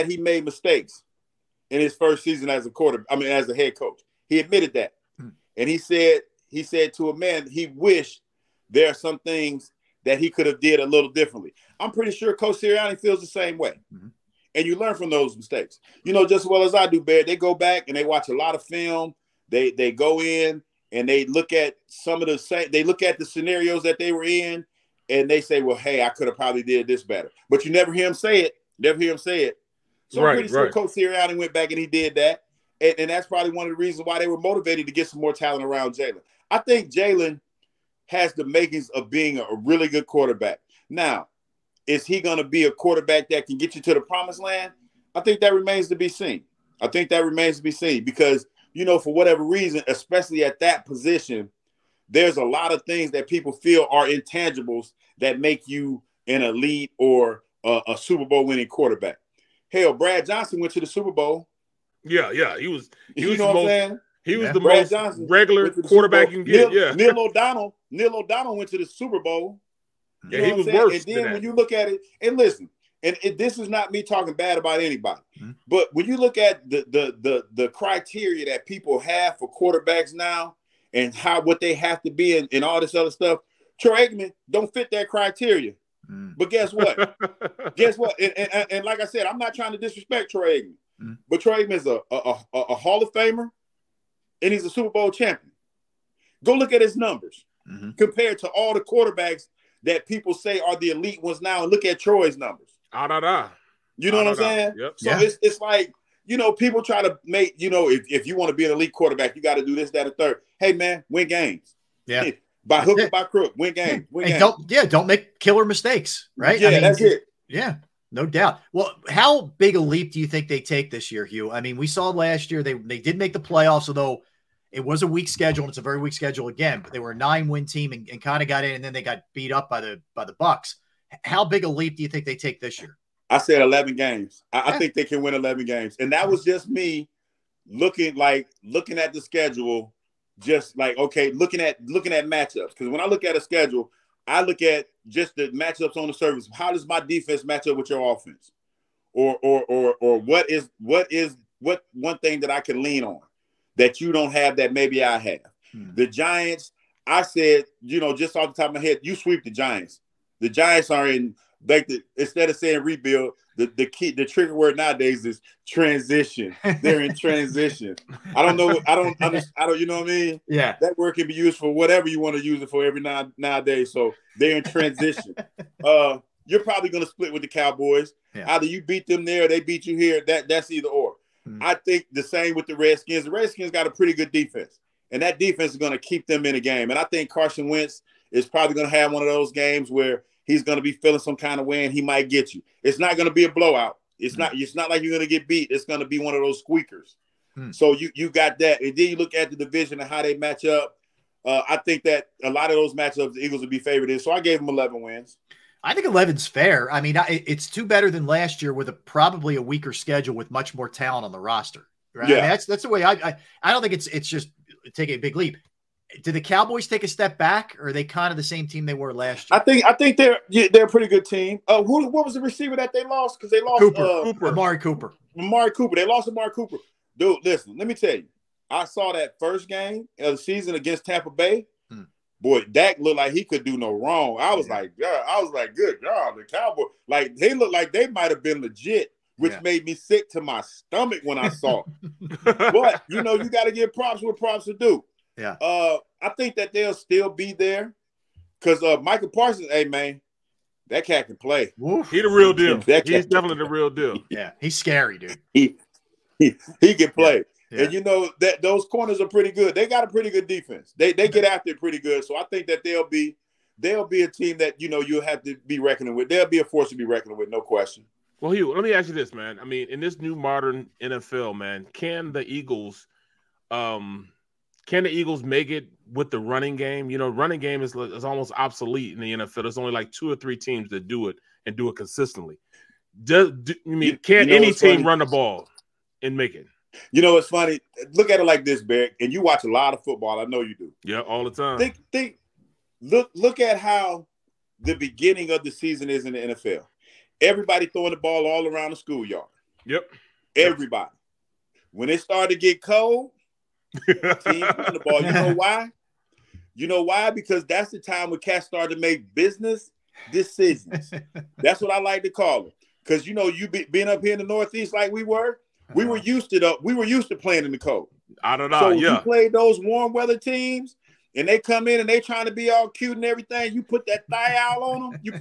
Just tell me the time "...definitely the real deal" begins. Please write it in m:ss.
4:13.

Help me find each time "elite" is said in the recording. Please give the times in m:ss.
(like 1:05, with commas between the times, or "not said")
0:56, 1:40, 1:48.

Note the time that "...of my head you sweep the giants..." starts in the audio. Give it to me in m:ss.
2:38.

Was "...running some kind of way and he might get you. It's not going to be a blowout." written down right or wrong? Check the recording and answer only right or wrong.
wrong.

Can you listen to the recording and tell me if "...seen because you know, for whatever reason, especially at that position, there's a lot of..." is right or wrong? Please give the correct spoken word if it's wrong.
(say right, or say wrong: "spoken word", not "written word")
right.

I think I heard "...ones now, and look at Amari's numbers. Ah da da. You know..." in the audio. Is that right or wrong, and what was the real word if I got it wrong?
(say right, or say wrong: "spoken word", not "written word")
wrong: "Troy", not "Amari".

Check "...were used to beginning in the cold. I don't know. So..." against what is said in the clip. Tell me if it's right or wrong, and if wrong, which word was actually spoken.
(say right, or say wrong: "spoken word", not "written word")
wrong: "playing", not "beginning".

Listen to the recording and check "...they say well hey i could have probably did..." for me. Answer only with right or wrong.
right.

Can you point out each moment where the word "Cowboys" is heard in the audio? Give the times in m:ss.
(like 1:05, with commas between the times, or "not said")
2:57, 3:36, 3:56.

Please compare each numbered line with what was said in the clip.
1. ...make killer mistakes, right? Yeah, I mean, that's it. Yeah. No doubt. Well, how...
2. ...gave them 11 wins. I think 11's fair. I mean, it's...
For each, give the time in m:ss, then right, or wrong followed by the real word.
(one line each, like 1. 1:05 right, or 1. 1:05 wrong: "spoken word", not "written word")
1. 1:55 right
2. 3:24 right.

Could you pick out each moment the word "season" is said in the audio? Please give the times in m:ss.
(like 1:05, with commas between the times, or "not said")
0:02, 3:50, 4:55.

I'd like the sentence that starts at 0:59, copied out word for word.
Hell, Brad Johnson went to the Super Bowl.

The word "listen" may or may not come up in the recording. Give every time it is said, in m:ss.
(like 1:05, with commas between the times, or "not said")
1:12, 3:47.